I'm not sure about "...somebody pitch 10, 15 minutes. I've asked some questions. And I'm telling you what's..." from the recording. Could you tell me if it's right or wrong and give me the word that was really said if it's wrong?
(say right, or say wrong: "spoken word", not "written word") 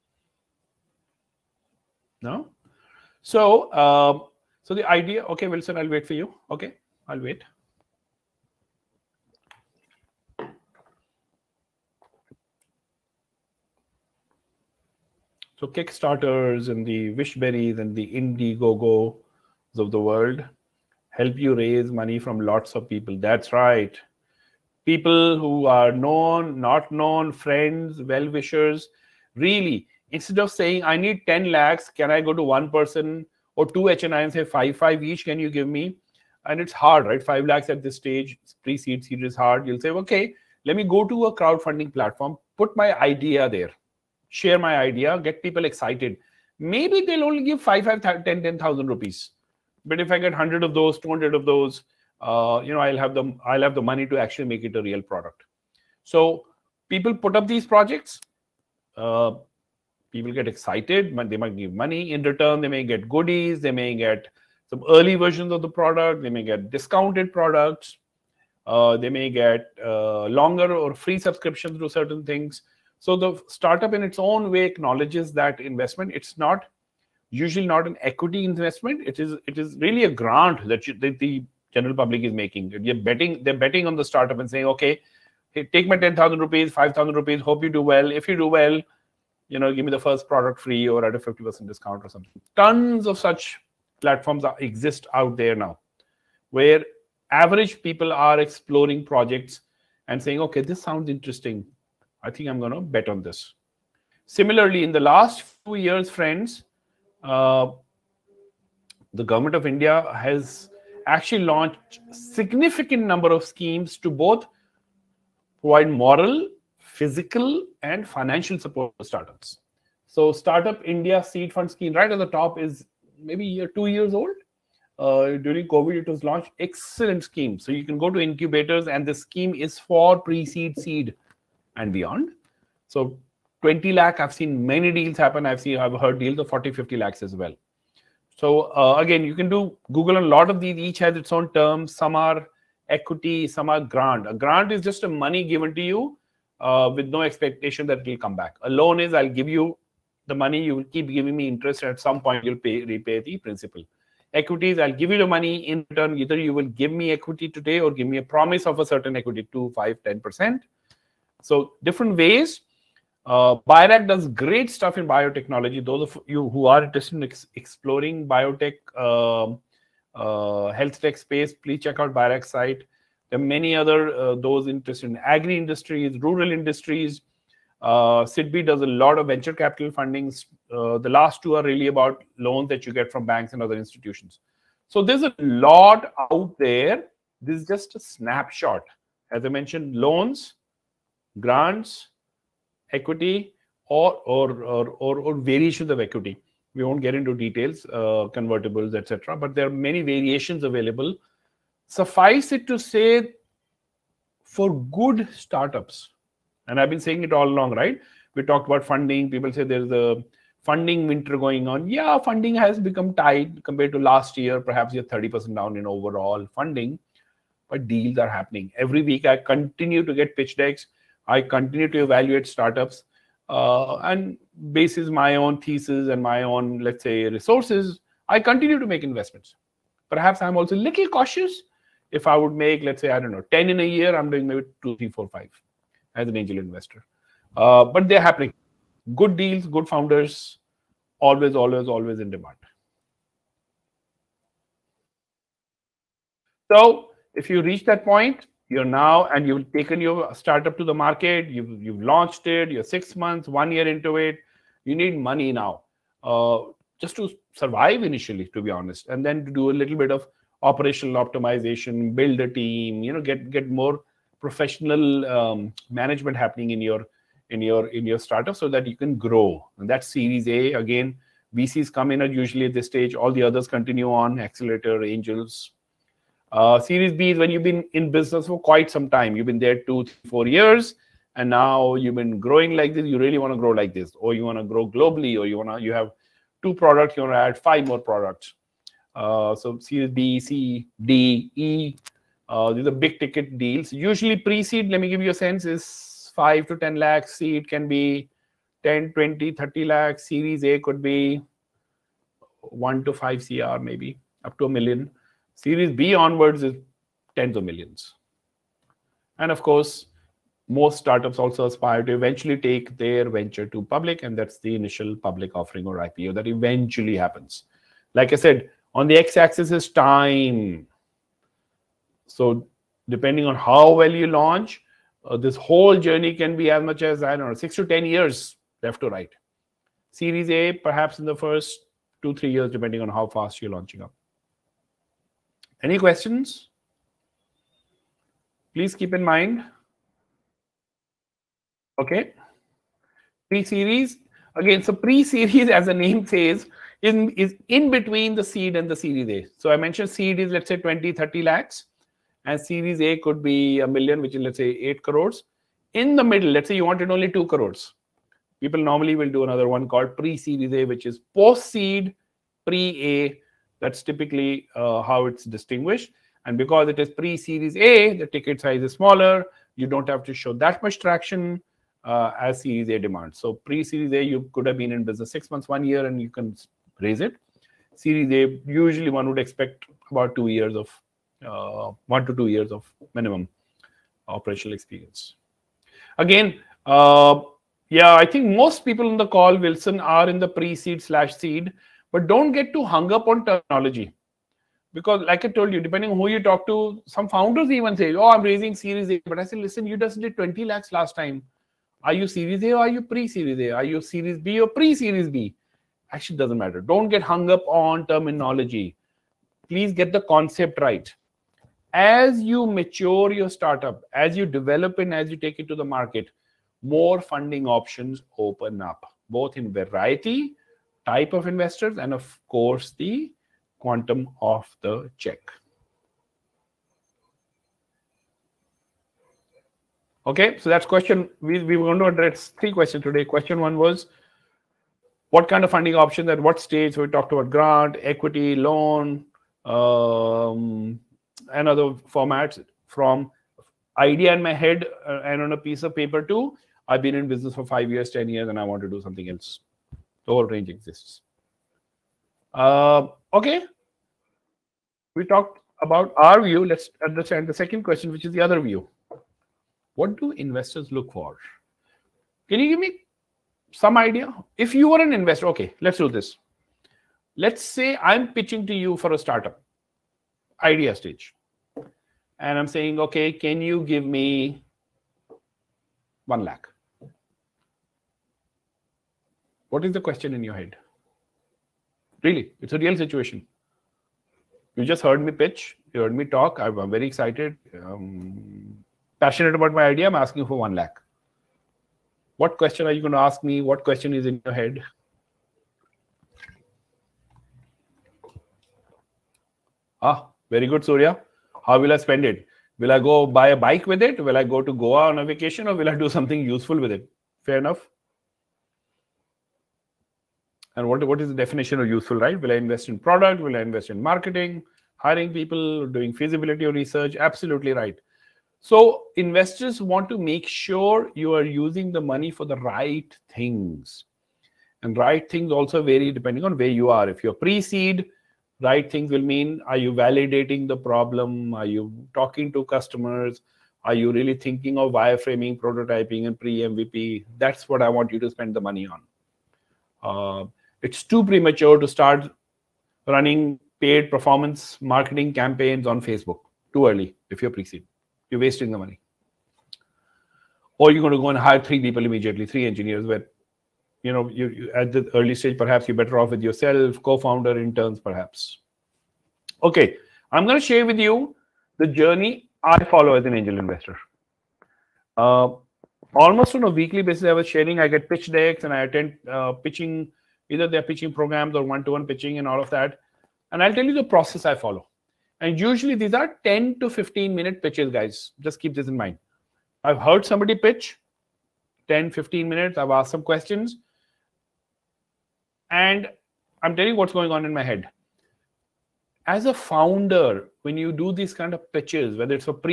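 right.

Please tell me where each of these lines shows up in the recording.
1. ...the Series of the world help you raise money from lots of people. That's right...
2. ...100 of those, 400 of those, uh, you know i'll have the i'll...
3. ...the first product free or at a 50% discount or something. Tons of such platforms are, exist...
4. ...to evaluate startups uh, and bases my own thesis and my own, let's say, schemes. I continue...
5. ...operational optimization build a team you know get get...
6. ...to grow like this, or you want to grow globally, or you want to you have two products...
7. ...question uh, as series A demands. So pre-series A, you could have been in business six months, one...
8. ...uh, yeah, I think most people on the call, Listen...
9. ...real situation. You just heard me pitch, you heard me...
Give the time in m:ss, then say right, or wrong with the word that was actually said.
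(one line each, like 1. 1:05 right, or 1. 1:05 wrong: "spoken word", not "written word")
1. 0:17 wrong: "Indiegogo", not "Series"
2. 0:50 wrong: "200", not "400"
3. 1:29 right
4. 3:41 wrong: "resources", not "schemes"
5. 4:20 right
6. 4:43 right
7. 6:10 wrong: "traction", not "question"
8. 6:26 wrong: "Wilson", not "Listen"
9. 8:02 right.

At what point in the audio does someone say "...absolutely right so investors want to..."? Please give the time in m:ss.
8:37.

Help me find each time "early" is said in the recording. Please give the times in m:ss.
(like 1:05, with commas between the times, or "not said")
1:04, 9:06, 9:15.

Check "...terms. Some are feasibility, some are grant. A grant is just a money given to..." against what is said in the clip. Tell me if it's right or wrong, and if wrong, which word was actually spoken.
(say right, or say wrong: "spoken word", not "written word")
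wrong: "equity", not "feasibility".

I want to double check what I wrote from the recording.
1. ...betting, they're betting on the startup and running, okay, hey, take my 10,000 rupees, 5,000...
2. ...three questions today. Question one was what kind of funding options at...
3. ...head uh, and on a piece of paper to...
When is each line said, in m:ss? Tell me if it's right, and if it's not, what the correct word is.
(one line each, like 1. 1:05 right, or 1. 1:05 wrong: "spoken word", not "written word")
1. 1:22 wrong: "saying", not "running"
2. 7:12 right
3. 7:24 right.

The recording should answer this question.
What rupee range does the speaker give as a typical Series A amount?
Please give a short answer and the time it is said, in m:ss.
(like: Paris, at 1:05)
1 to 5 crore, at 5:02.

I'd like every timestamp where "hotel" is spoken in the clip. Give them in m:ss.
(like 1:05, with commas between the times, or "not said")
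not said.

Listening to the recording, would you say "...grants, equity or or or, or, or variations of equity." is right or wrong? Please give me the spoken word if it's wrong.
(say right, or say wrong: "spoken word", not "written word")
right.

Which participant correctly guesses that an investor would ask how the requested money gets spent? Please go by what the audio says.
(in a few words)
Surya.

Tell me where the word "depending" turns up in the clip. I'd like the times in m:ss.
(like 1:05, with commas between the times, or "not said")
5:23, 5:32, 6:35, 8:46.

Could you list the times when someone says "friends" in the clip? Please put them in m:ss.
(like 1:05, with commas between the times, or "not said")
0:27, 1:46.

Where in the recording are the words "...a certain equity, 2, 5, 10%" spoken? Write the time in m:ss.
2:38.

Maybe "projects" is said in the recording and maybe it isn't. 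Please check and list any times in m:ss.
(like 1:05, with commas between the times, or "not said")
0:57, 1:39.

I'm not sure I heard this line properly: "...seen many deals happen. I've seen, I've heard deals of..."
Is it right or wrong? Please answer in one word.
right.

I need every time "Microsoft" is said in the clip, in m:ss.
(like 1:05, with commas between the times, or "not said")
not said.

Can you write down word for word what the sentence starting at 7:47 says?
Let's say I'm pitching to you for a startup idea stage.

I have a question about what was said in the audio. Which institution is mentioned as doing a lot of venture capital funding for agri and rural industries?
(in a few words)
SIDBI.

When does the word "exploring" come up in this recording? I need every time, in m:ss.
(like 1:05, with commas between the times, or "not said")
1:38, 2:47.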